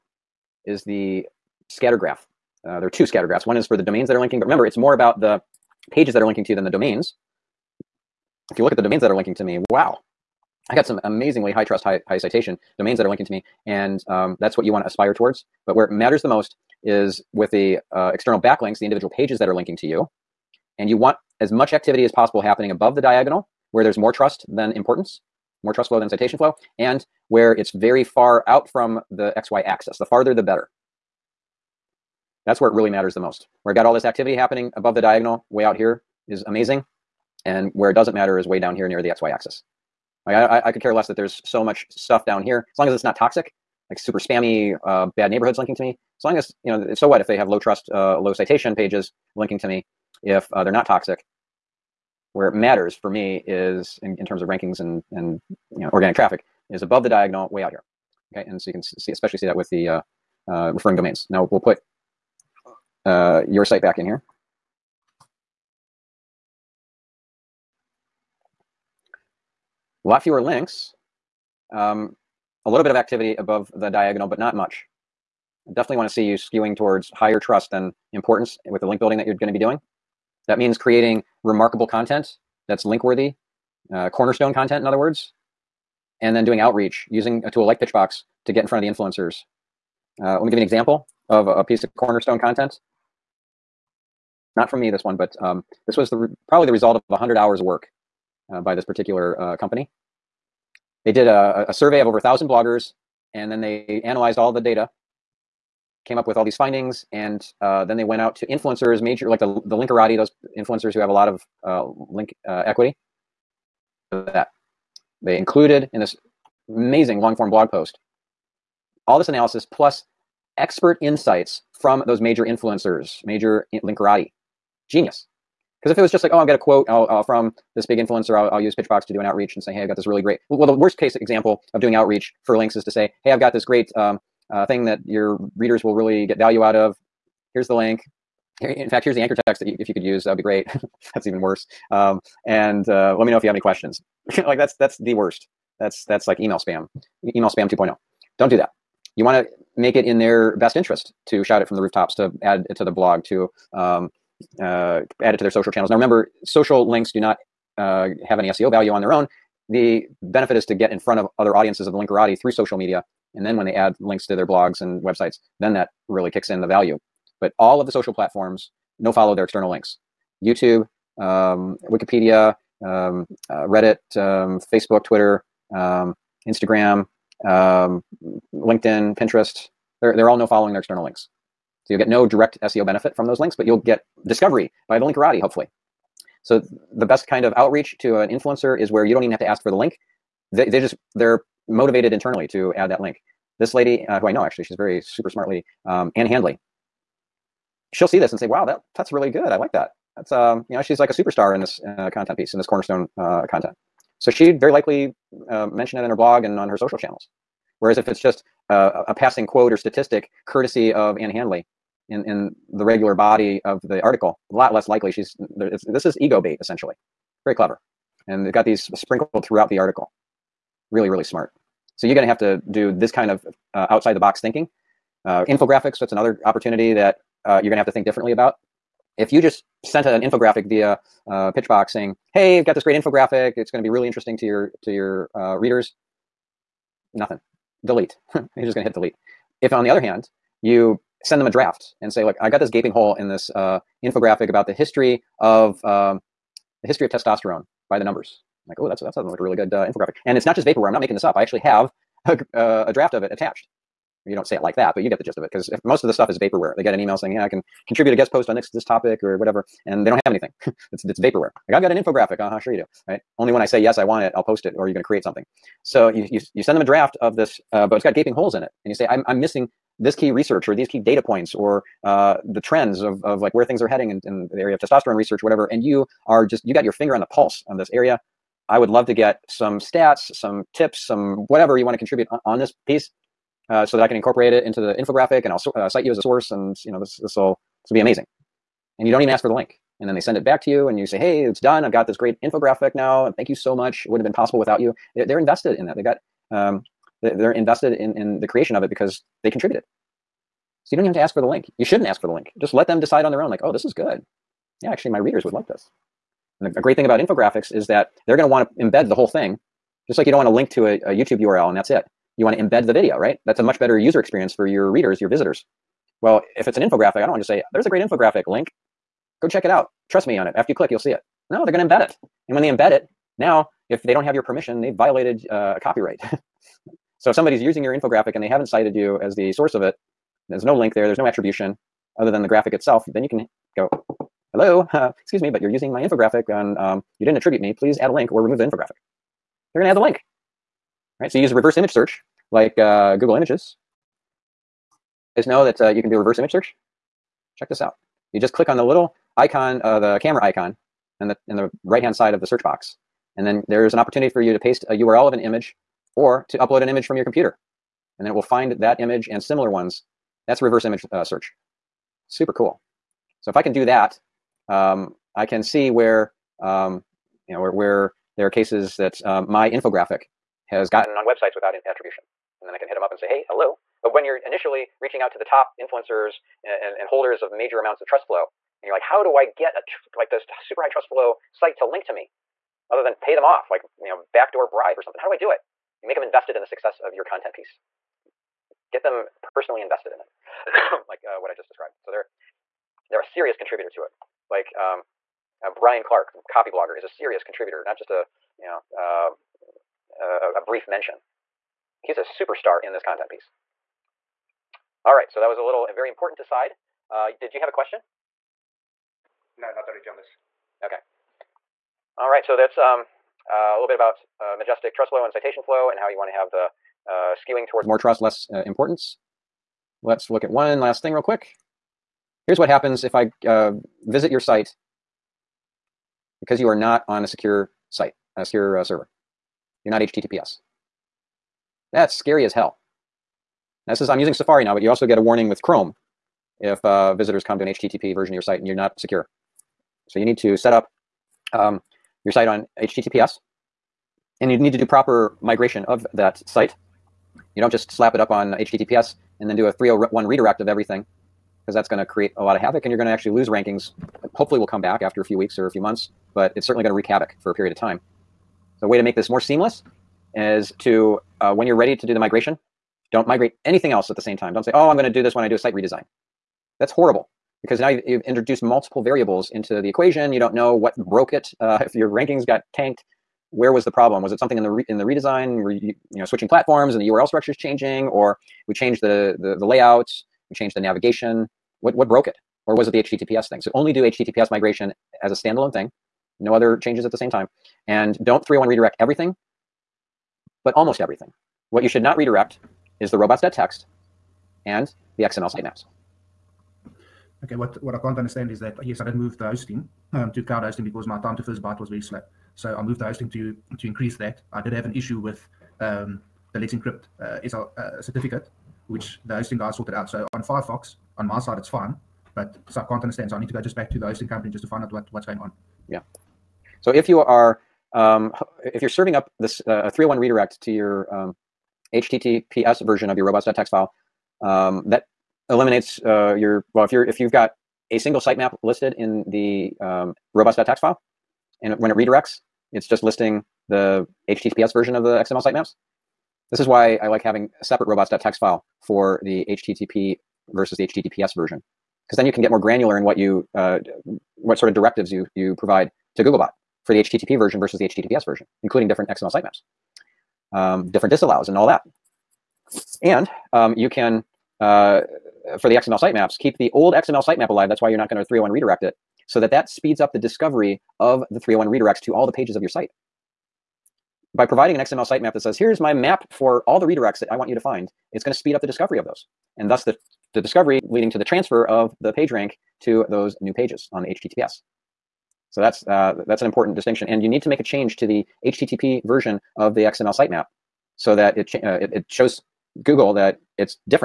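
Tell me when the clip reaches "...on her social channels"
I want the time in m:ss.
3:26.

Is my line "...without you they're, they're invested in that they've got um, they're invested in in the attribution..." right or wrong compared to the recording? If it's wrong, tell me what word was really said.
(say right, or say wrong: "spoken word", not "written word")
wrong: "creation", not "attribution".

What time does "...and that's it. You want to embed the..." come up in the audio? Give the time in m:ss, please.
5:11.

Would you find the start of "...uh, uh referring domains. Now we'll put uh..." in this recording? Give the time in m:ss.
0:59.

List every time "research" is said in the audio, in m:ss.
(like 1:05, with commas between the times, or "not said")
4:30, 4:35.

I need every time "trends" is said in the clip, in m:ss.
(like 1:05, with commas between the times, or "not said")
4:32.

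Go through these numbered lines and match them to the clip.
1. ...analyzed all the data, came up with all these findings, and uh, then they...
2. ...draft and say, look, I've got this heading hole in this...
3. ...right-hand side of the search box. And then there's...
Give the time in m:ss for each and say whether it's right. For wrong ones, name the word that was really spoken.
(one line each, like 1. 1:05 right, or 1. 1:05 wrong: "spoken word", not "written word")
1. 1:44 right
2. 4:01 wrong: "gaping", not "heading"
3. 5:51 right.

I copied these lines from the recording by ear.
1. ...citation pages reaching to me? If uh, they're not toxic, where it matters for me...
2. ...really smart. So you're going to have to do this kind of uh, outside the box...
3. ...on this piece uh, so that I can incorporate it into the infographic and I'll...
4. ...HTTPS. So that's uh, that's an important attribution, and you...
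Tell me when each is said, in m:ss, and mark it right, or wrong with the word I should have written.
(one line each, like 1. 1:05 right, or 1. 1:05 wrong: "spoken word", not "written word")
1. 0:48 wrong: "linking", not "reaching"
2. 3:41 right
3. 4:42 right
4. 9:34 wrong: "distinction", not "attribution".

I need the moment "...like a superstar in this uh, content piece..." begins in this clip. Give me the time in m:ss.
3:20.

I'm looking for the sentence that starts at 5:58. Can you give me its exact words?
And then it will find that image and similar ones.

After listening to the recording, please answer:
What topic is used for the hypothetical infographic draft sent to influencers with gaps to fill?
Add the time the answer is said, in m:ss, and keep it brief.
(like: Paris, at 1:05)
history of testosterone, at 4:06.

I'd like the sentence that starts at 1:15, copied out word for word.
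I definitely want to see you skewing towards higher trust than importance with the link building that you're going to be doing.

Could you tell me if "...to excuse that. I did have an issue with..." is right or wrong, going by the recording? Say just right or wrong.
wrong.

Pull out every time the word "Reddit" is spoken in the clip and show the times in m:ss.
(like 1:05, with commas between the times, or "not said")
2:53.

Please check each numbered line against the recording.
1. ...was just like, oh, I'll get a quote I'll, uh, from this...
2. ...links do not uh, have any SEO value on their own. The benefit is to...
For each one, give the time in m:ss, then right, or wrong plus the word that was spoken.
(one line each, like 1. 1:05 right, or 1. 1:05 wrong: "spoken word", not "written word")
1. 2:06 right
2. 2:36 right.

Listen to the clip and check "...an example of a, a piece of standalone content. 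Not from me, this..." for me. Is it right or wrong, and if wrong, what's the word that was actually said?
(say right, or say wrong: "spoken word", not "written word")
wrong: "cornerstone", not "standalone".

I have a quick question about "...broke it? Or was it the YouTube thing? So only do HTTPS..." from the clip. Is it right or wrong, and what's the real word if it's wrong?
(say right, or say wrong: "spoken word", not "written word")
wrong: "HTTPS", not "YouTube".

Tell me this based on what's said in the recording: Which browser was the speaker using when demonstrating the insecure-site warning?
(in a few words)
Safari.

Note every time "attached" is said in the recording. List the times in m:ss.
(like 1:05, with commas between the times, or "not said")
4:13.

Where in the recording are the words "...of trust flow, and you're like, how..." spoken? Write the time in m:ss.
6:18.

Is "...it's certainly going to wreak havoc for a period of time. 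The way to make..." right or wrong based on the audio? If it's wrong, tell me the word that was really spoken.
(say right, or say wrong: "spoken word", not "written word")
right.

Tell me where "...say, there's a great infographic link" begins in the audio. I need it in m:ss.
5:17.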